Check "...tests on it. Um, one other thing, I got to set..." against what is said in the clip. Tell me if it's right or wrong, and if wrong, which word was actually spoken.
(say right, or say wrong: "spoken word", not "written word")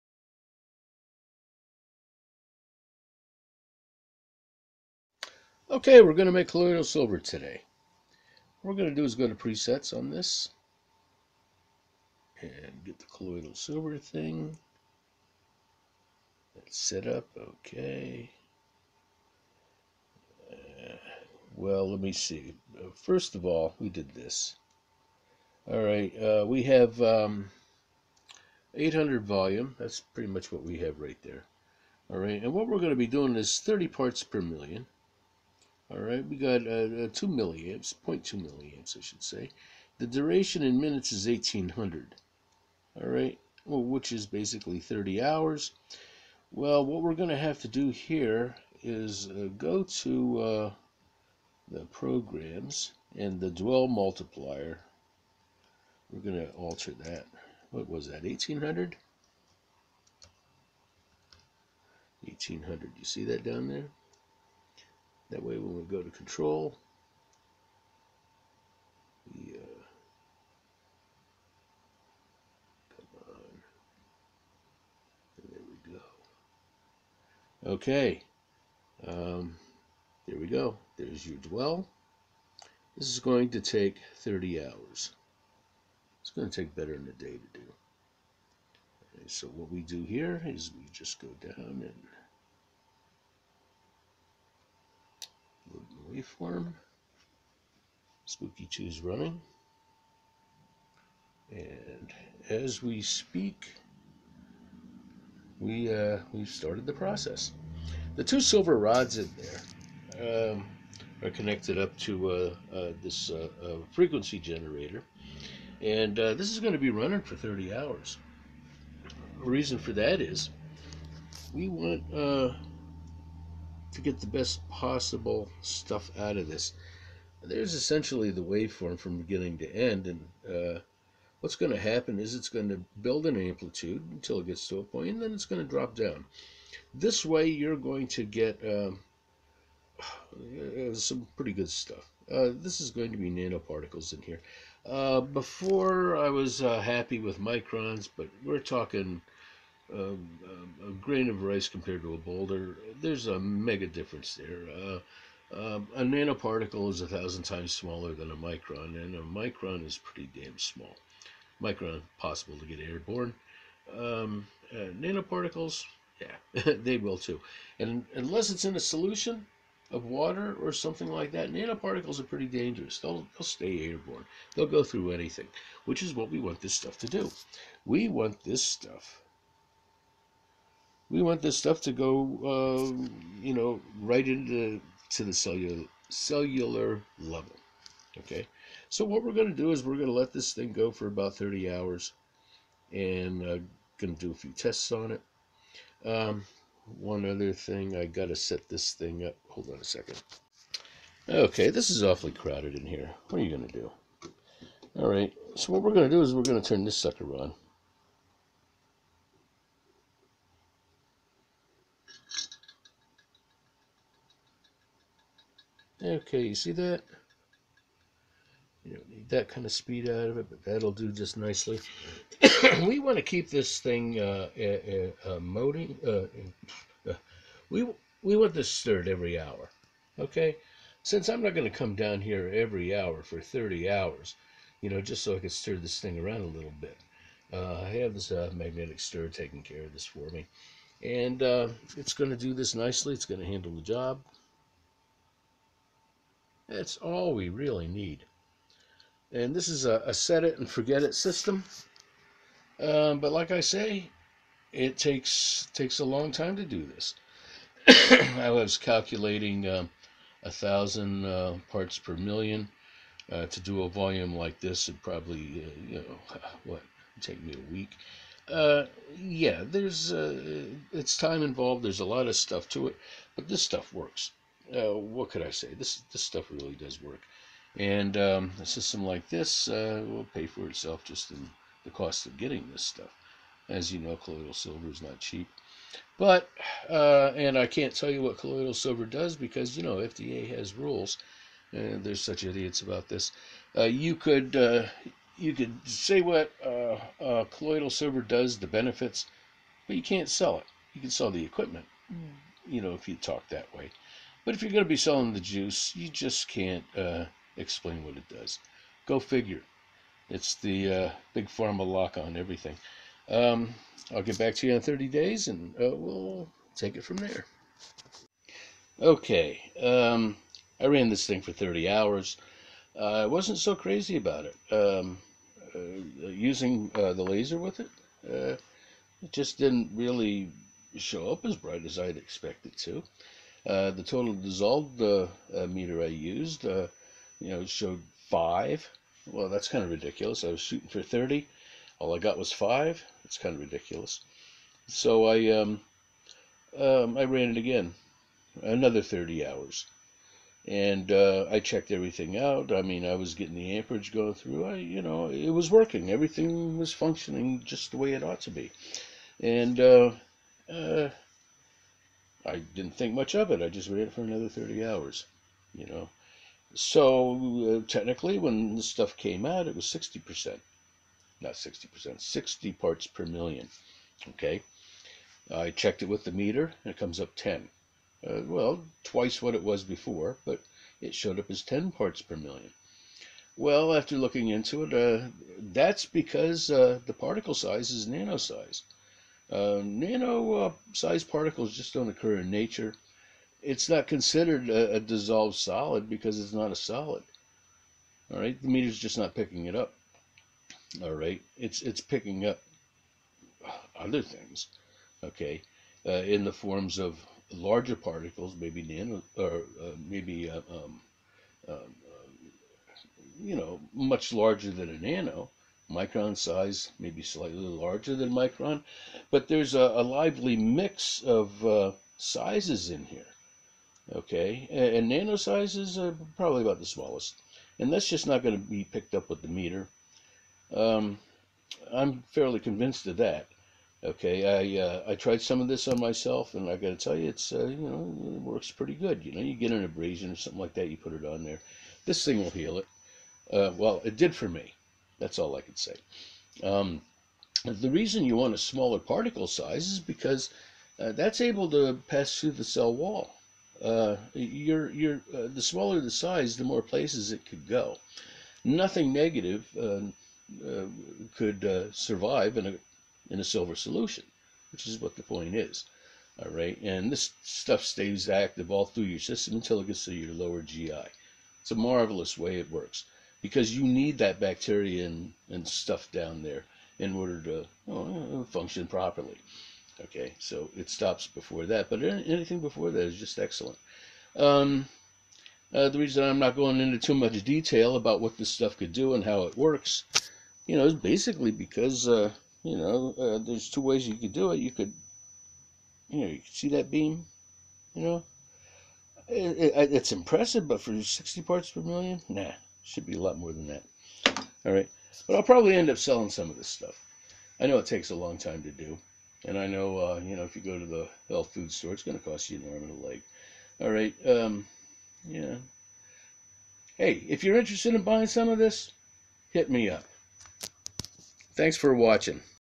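right.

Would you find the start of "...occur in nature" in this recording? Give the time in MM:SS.
06:32.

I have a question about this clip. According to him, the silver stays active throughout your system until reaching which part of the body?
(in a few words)
lower GI.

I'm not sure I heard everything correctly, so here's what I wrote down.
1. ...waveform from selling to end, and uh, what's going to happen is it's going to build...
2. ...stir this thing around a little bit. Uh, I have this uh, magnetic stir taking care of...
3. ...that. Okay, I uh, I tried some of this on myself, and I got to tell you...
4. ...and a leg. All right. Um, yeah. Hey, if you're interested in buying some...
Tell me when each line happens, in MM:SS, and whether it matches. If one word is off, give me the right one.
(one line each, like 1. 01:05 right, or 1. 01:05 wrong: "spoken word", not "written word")
1. 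02:08 wrong: "beginning", not "selling"
2. 03:55 right
3. 07:13 right
4. 08:32 right.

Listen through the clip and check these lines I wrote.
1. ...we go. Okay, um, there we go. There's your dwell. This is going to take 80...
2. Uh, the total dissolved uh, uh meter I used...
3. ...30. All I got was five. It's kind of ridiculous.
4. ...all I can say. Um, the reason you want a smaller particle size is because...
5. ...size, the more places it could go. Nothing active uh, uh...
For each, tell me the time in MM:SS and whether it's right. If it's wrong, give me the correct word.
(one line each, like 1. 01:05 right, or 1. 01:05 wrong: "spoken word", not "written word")
1. 01:15 wrong: "30", not "80"
2. 05:33 right
3. 05:41 right
4. 07:25 right
5. 07:36 wrong: "negative", not "active".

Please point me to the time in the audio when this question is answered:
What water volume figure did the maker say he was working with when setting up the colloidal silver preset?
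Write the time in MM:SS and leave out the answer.
00:28.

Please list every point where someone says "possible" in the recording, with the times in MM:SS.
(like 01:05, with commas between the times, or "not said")
02:04, 02:42.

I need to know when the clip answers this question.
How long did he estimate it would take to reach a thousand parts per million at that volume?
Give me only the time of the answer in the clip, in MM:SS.
04:27.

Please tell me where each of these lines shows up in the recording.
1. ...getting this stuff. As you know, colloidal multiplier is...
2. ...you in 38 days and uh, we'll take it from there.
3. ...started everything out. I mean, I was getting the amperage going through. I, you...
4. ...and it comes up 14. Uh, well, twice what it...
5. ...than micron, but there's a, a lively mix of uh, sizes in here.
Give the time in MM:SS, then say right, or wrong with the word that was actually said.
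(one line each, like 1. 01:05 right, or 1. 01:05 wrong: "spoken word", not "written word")
1. 04:42 wrong: "silver", not "multiplier"
2. 05:14 wrong: "30", not "38"
3. 05:51 wrong: "checked", not "started"
4. 06:16 wrong: "10", not "14"
5. 06:58 right.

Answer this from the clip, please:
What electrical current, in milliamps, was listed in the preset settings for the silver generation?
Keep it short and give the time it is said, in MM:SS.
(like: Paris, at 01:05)
0.2 milliamps, at 00:38.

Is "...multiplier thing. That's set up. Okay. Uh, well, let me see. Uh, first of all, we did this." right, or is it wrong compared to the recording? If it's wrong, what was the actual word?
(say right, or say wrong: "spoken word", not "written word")
wrong: "silver", not "multiplier".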